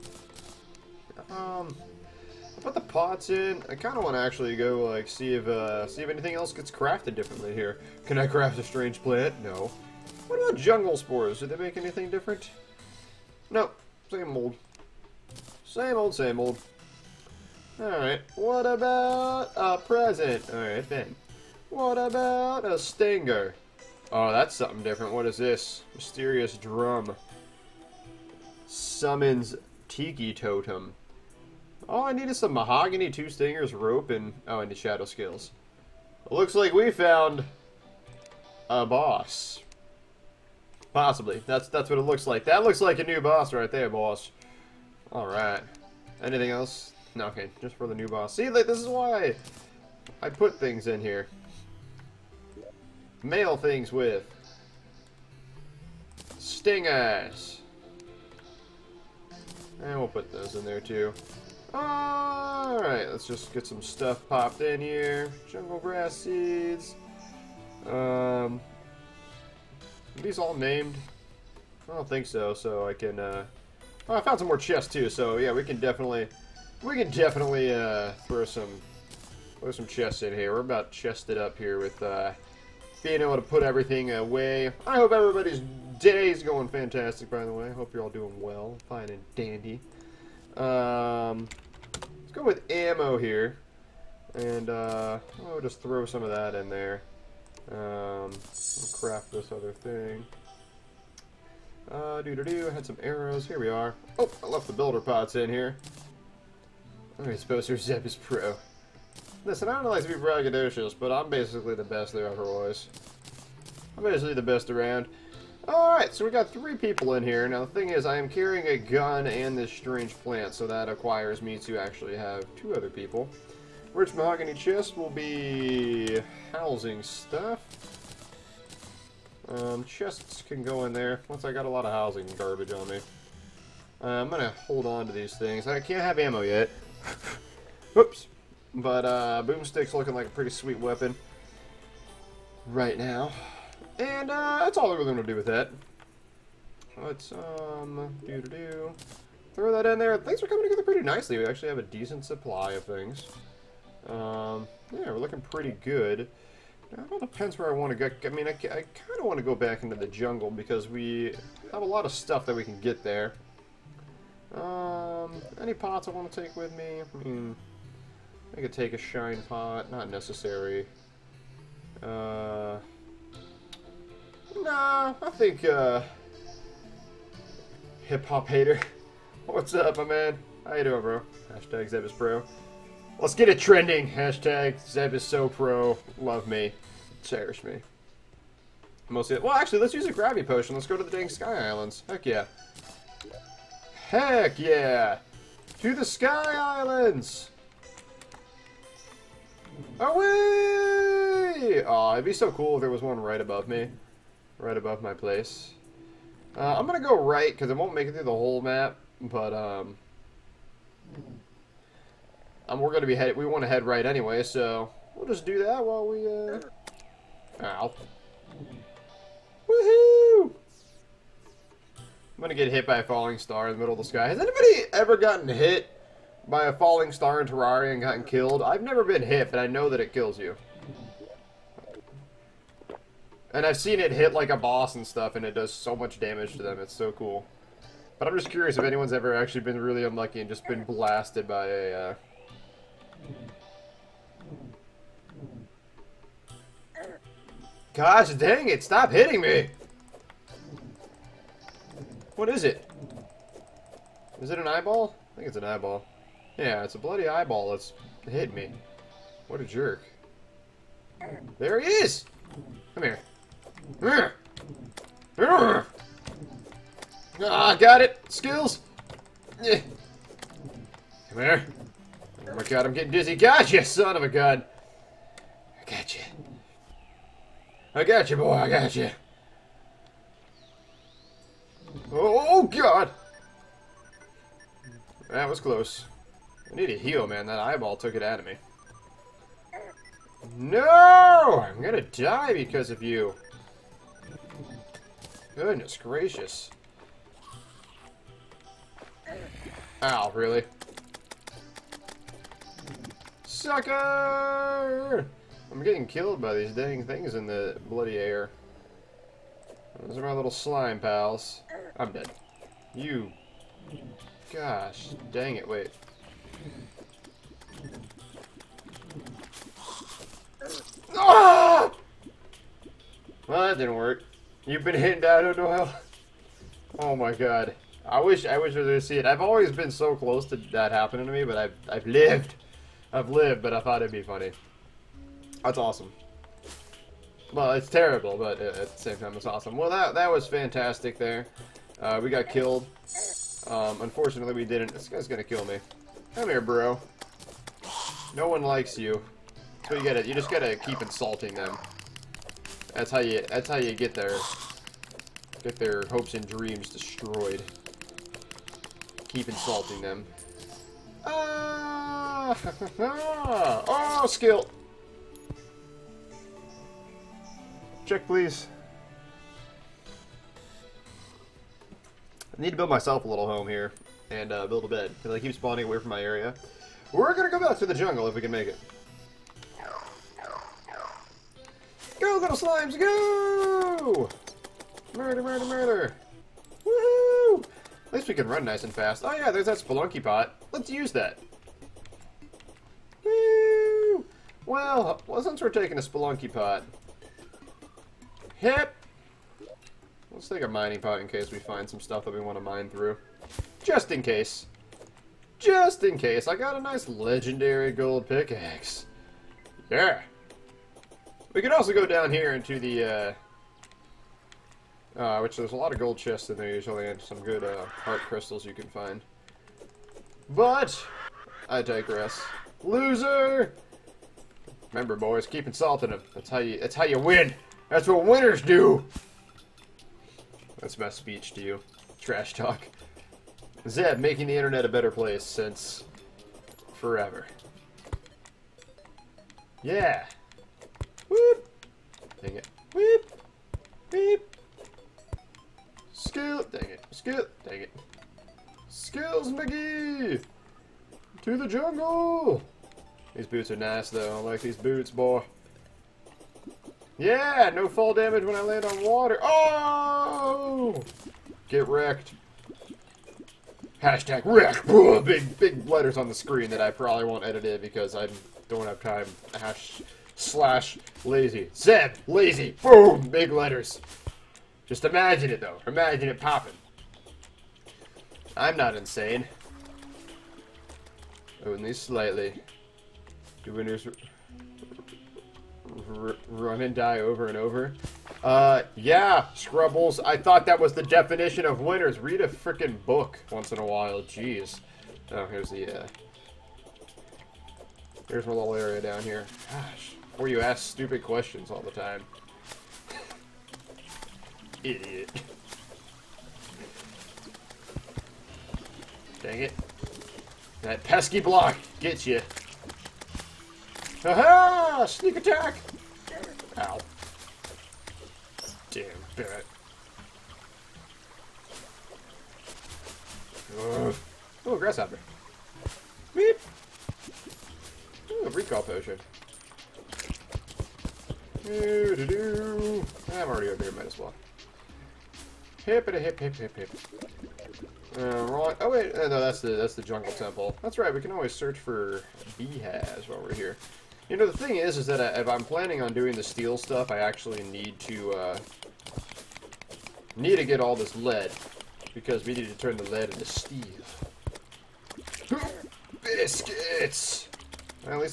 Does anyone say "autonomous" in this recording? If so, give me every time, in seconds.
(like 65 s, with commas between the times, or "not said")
not said.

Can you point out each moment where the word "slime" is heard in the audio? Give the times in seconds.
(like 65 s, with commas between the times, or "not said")
310 s, 382 s.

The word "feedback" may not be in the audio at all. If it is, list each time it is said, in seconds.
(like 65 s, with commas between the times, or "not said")
not said.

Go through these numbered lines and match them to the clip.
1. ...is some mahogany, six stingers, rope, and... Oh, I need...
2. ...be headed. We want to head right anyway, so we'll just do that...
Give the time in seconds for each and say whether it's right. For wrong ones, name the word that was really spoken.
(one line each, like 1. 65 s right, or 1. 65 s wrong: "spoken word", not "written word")
1. 32 s wrong: "two", not "six"
2. 213 s right.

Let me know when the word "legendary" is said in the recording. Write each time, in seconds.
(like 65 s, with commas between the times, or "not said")
407 s.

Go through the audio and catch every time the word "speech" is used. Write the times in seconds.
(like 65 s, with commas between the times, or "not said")
431 s.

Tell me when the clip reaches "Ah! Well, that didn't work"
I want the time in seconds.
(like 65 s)
321 s.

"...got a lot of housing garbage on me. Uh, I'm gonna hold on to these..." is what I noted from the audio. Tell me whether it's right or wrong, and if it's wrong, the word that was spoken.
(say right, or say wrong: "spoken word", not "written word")
right.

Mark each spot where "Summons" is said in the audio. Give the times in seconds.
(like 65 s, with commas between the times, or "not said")
28 s.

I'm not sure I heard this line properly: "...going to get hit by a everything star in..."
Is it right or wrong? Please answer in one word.
wrong.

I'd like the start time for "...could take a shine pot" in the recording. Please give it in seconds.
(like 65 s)
168 s.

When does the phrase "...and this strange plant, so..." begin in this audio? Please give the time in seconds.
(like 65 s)
119 s.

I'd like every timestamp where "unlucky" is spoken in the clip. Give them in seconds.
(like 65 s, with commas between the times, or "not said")
240 s.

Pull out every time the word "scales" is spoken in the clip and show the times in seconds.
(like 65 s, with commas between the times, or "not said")
35 s.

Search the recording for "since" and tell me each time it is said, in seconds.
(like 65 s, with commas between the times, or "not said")
395 s, 435 s.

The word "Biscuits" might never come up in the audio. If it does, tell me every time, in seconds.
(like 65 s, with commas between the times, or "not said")
556 s.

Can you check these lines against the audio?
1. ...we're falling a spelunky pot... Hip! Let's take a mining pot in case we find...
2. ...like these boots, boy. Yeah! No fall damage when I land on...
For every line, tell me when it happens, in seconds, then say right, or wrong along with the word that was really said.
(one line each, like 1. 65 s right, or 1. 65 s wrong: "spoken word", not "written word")
1. 395 s wrong: "taking", not "falling"
2. 454 s right.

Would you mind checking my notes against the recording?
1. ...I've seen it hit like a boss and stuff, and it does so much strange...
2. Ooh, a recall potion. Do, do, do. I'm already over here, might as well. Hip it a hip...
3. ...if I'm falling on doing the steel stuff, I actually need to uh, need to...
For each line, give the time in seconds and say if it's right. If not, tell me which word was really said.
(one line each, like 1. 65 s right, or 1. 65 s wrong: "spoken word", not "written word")
1. 233 s wrong: "damage", not "strange"
2. 528 s right
3. 545 s wrong: "planning", not "falling".